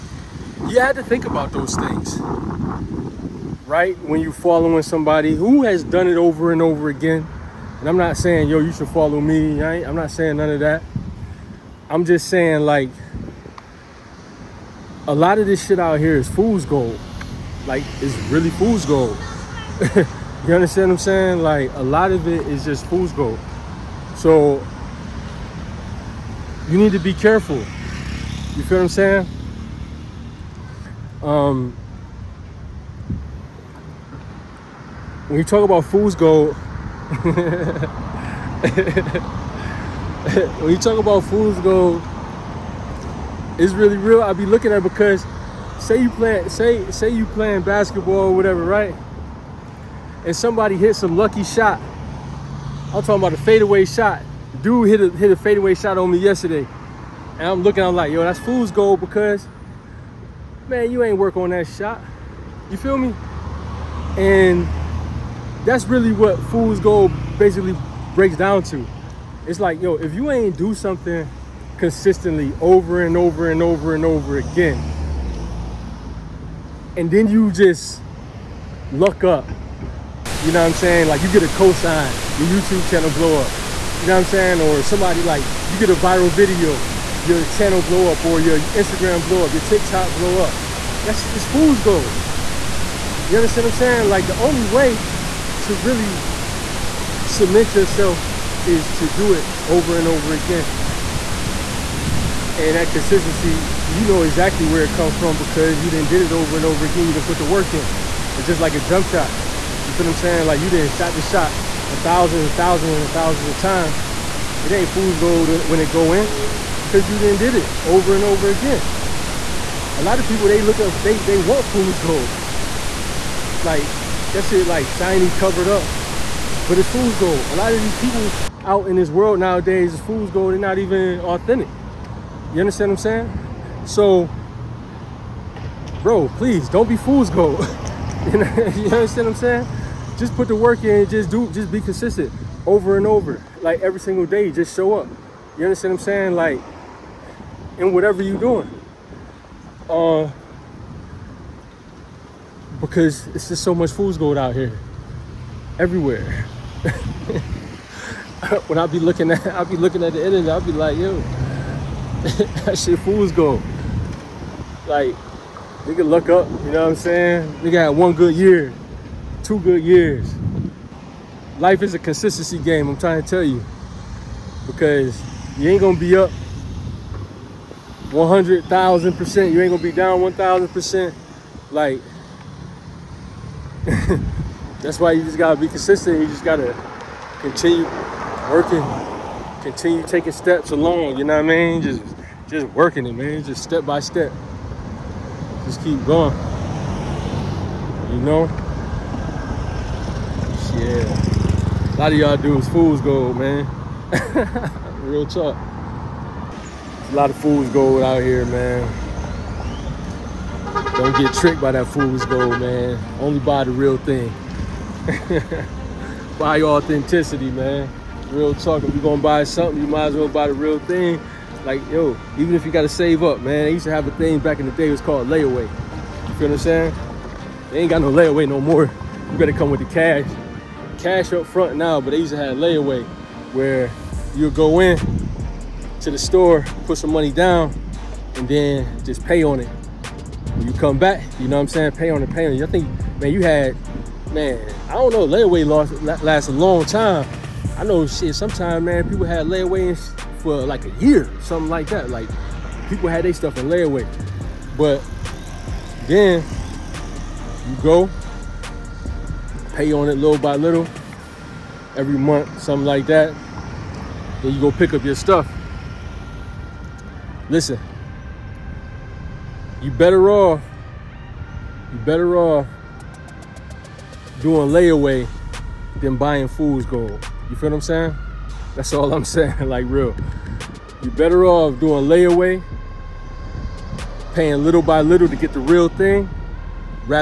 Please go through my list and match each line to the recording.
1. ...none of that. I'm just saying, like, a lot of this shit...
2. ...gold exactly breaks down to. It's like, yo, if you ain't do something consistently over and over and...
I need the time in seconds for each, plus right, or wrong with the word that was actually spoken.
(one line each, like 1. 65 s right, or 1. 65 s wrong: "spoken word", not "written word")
1. 10 s right
2. 66 s wrong: "basically", not "exactly".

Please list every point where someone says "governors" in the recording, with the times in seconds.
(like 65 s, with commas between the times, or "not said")
not said.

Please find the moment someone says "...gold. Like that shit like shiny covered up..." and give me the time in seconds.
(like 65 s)
121 s.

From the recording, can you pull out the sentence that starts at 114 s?
It ain't fool's gold when it go in because you didn't did it over and over again.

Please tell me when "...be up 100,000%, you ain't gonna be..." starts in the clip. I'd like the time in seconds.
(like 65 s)
175 s.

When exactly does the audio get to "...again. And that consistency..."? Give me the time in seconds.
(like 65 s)
100 s.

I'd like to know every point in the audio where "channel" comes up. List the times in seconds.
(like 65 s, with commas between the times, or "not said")
82 s, 87 s.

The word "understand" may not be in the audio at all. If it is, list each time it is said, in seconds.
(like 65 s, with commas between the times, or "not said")
20 s, 93 s, 132 s, 138 s, 145 s.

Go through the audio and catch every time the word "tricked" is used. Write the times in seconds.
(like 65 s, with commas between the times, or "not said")
211 s.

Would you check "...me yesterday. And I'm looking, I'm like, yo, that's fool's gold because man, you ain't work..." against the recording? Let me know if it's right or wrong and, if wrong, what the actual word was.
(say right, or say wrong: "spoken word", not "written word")
right.